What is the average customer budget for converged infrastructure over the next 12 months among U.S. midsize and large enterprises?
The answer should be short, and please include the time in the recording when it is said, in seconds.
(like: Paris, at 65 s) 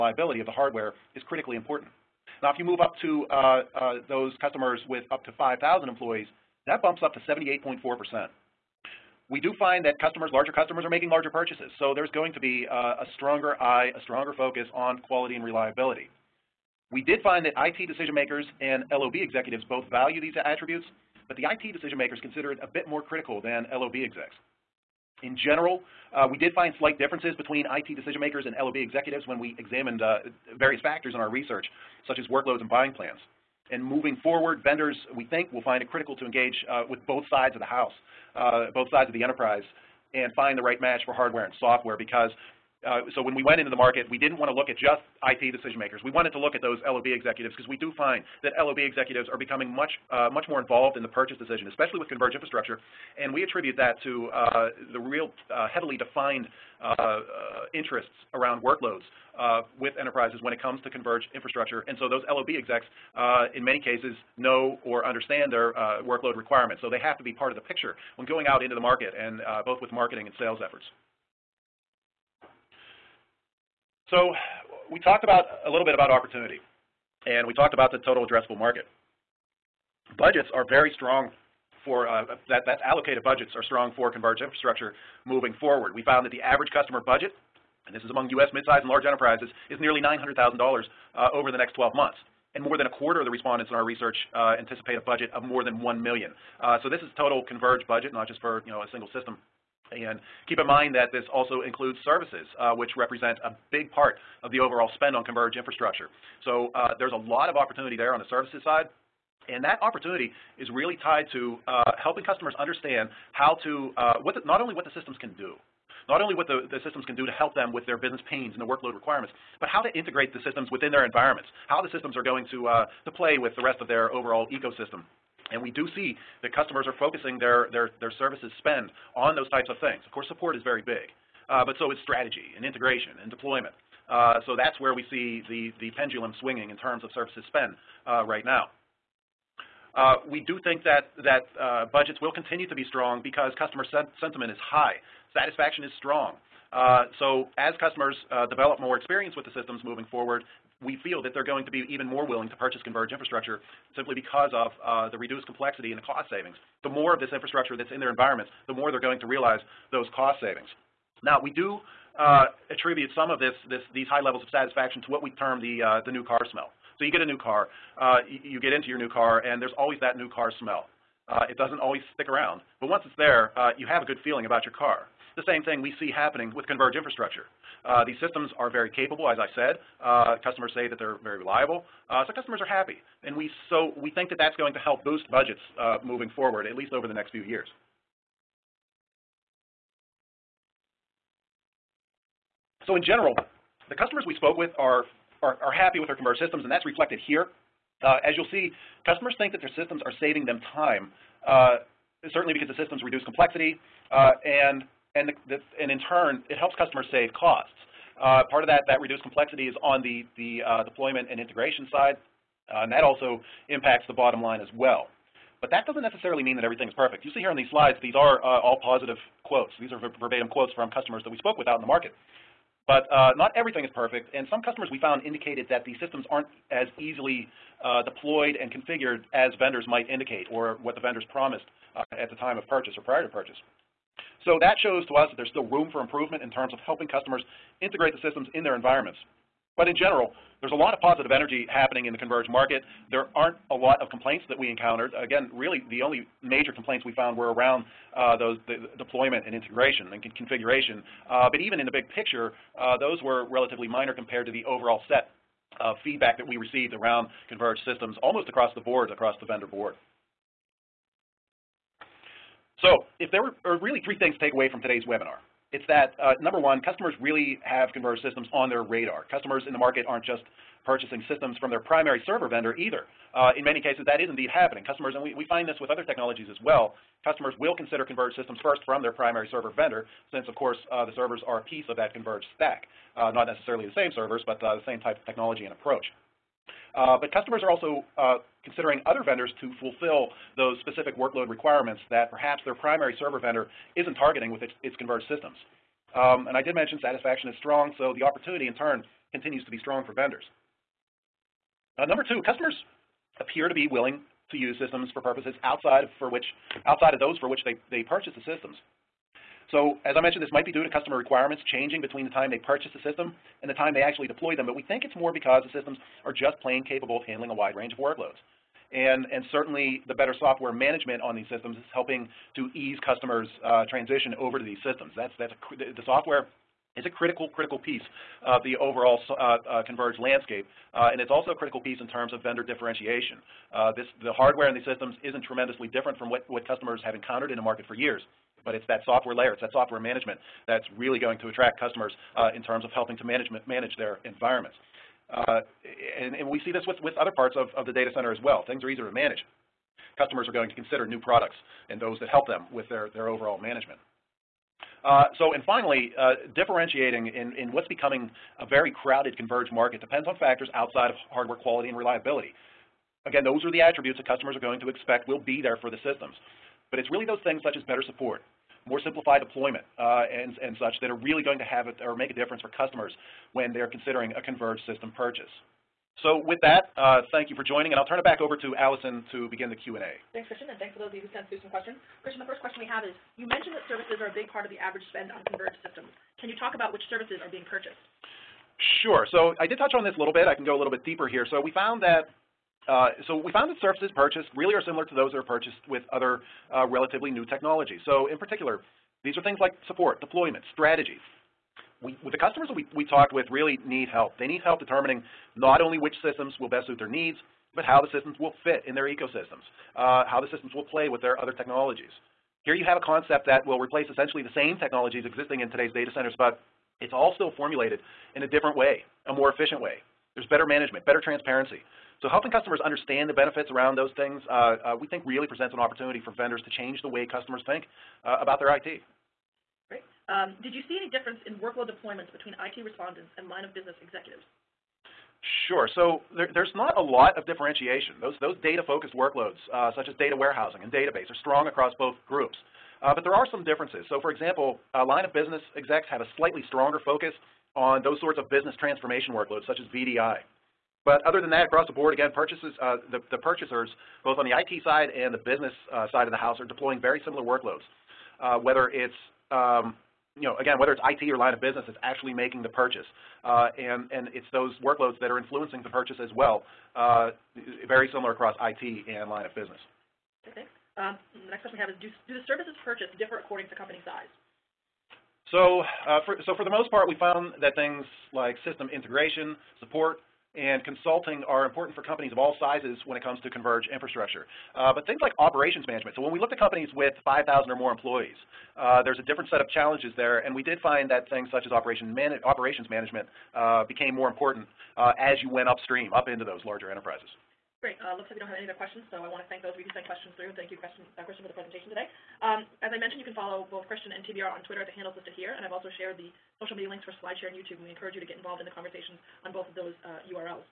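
nearly $900,000, at 89 s.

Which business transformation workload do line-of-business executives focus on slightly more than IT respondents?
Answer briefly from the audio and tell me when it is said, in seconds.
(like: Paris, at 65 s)
VDI, at 449 s.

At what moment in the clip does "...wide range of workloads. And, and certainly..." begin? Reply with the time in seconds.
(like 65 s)
317 s.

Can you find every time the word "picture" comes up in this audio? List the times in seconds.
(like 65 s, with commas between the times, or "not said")
67 s, 252 s.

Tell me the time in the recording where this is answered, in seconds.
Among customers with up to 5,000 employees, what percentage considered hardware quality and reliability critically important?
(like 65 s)
7 s.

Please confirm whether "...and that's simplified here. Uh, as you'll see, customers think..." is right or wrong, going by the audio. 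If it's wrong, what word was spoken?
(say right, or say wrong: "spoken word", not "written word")
wrong: "reflected", not "simplified".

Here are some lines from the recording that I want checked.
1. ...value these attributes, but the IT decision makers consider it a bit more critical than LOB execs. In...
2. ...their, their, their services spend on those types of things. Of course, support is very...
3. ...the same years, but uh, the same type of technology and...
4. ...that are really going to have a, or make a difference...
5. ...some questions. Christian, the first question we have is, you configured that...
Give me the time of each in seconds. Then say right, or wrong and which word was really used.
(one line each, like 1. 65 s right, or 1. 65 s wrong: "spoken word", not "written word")
1. 19 s right
2. 127 s right
3. 283 s wrong: "servers", not "years"
4. 371 s right
5. 381 s wrong: "mentioned", not "configured".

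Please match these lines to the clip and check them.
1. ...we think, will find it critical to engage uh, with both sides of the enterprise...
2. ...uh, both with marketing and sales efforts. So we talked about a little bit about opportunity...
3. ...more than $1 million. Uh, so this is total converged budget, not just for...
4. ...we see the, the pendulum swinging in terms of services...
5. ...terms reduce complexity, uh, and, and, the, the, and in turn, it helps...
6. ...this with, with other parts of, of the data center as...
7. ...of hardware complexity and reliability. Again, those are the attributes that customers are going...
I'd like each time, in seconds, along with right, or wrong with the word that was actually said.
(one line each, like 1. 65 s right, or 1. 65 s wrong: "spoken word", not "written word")
1. 35 s wrong: "house", not "enterprise"
2. 69 s right
3. 95 s right
4. 134 s right
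5. 202 s wrong: "systems", not "terms"
6. 346 s right
7. 361 s wrong: "quality", not "complexity".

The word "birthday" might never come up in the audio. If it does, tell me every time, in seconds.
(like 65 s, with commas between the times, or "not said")
not said.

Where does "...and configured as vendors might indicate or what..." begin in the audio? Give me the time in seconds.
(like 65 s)
228 s.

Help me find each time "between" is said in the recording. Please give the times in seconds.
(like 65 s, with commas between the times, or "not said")
27 s, 312 s, 432 s.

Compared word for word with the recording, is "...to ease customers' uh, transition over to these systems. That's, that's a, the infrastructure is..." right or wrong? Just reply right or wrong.
wrong.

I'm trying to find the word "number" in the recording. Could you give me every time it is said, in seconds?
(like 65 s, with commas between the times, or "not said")
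266 s, 302 s.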